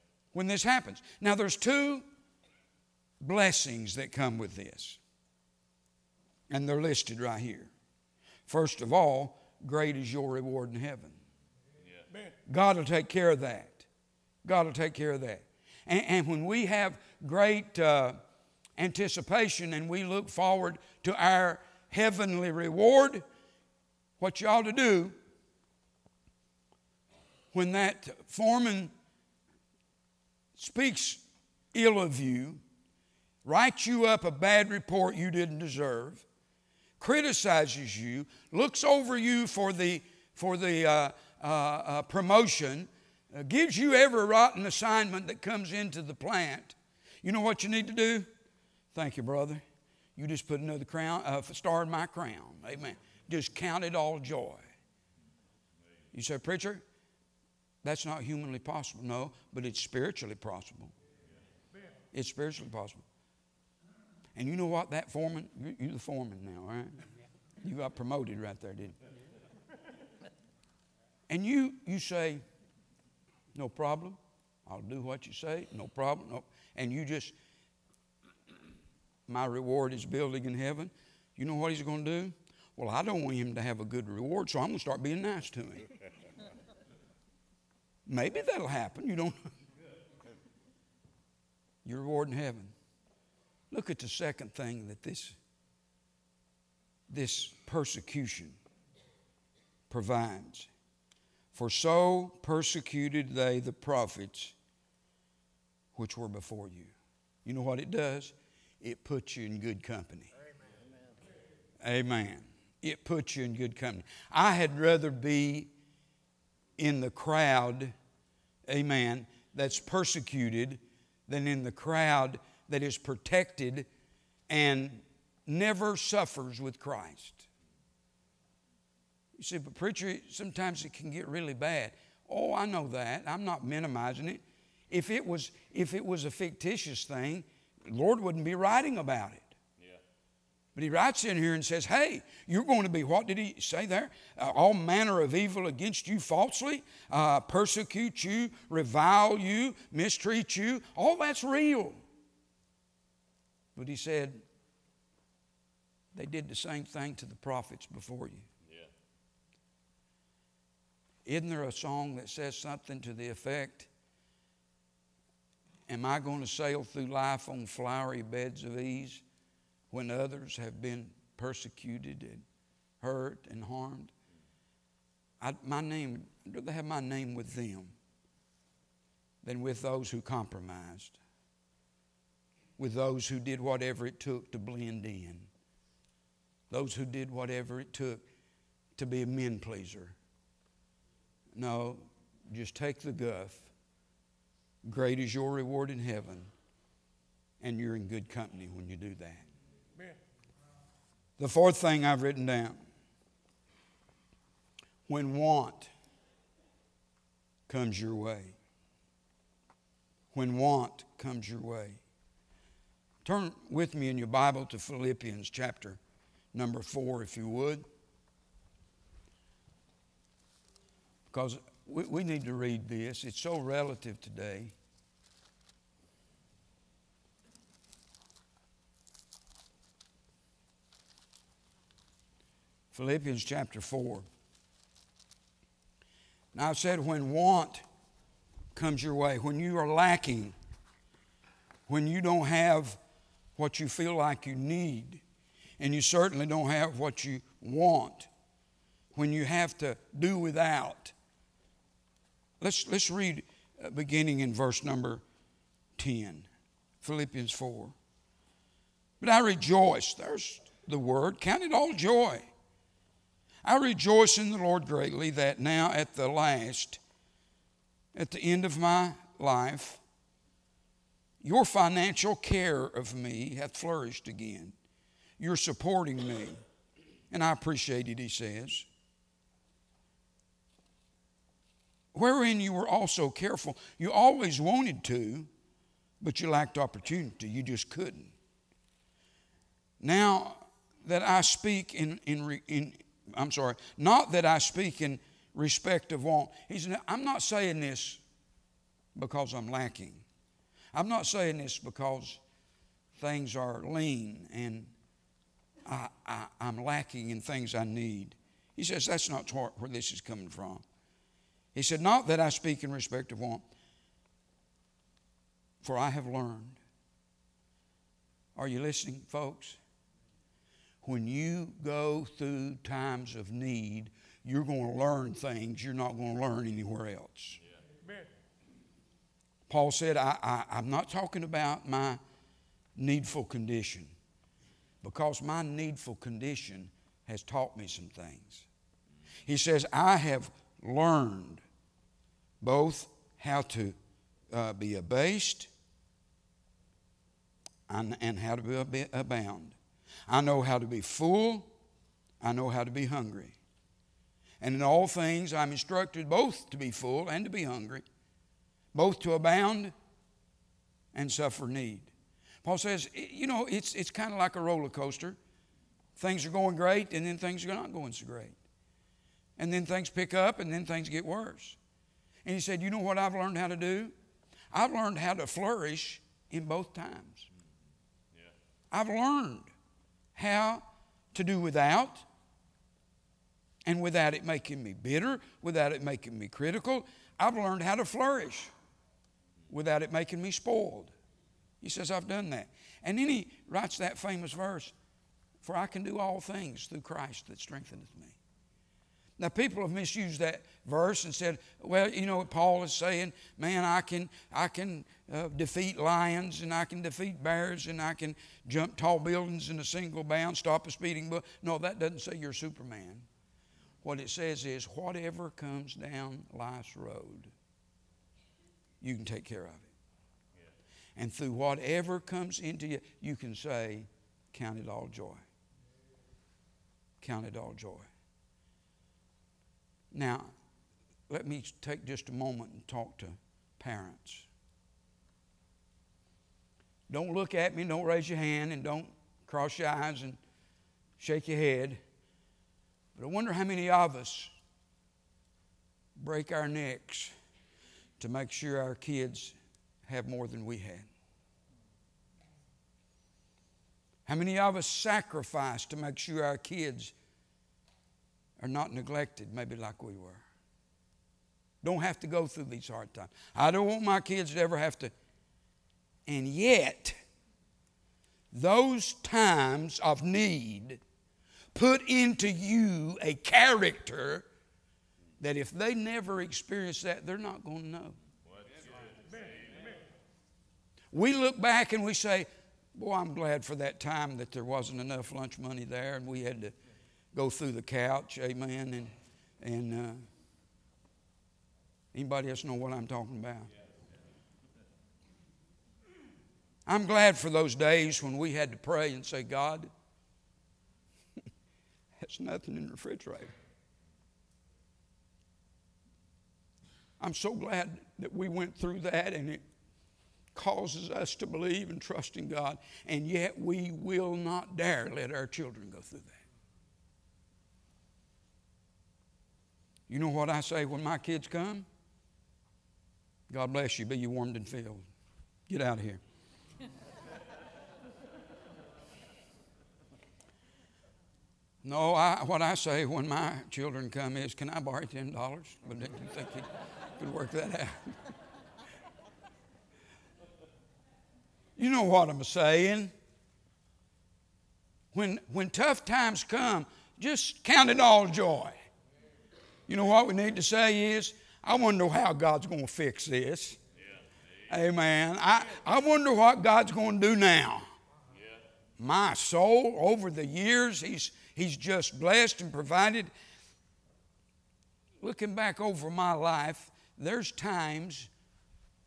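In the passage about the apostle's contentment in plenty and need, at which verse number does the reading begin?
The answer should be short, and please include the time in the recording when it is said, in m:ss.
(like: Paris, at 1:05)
10, at 4:14.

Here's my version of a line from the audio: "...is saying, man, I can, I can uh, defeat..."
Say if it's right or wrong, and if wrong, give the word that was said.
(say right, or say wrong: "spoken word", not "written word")
right.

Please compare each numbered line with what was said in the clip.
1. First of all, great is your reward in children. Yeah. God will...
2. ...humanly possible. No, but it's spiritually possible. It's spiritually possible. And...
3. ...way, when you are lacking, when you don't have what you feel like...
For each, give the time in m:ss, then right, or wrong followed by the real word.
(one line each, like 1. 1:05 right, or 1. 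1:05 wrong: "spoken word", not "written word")
1. 0:08 wrong: "heaven", not "children"
2. 0:58 right
3. 3:59 right.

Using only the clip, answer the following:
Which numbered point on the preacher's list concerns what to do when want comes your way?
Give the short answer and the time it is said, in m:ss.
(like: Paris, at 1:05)
The fourth, at 3:21.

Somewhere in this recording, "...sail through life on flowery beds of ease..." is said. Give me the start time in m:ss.
2:46.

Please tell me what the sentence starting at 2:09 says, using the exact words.
You see, but preacher, sometimes it can get really bad.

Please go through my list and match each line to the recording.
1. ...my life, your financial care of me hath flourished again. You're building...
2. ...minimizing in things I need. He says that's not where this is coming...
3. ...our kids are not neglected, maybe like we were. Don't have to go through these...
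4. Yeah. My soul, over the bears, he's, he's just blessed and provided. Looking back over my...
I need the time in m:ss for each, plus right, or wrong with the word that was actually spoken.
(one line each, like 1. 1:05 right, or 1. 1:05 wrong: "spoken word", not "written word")
1. 4:28 wrong: "supporting", not "building"
2. 5:06 wrong: "lacking", not "minimizing"
3. 7:36 right
4. 9:18 wrong: "years", not "bears".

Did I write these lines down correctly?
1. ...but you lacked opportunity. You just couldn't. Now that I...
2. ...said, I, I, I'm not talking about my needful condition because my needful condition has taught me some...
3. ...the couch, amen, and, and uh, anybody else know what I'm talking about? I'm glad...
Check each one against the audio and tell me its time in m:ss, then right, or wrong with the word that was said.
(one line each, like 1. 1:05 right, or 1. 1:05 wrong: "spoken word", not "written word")
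1. 4:46 right
2. 5:29 right
3. 8:07 right.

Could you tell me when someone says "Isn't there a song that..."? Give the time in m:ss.
2:41.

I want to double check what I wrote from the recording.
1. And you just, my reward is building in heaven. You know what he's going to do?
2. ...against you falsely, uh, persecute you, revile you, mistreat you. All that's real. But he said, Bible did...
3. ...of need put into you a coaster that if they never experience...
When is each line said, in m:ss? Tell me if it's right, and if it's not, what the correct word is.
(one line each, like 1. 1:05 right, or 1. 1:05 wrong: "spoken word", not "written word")
1. 1:16 right
2. 2:25 wrong: "They", not "Bible"
3. 7:49 wrong: "character", not "coaster".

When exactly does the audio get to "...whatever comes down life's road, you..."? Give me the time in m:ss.
6:54.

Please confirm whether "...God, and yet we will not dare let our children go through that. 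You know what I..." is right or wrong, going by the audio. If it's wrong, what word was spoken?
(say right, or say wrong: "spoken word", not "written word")
right.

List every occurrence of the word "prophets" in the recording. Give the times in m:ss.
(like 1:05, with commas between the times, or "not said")
1:43, 2:37.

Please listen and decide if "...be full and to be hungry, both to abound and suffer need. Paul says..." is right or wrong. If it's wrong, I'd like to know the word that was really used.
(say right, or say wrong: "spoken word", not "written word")
right.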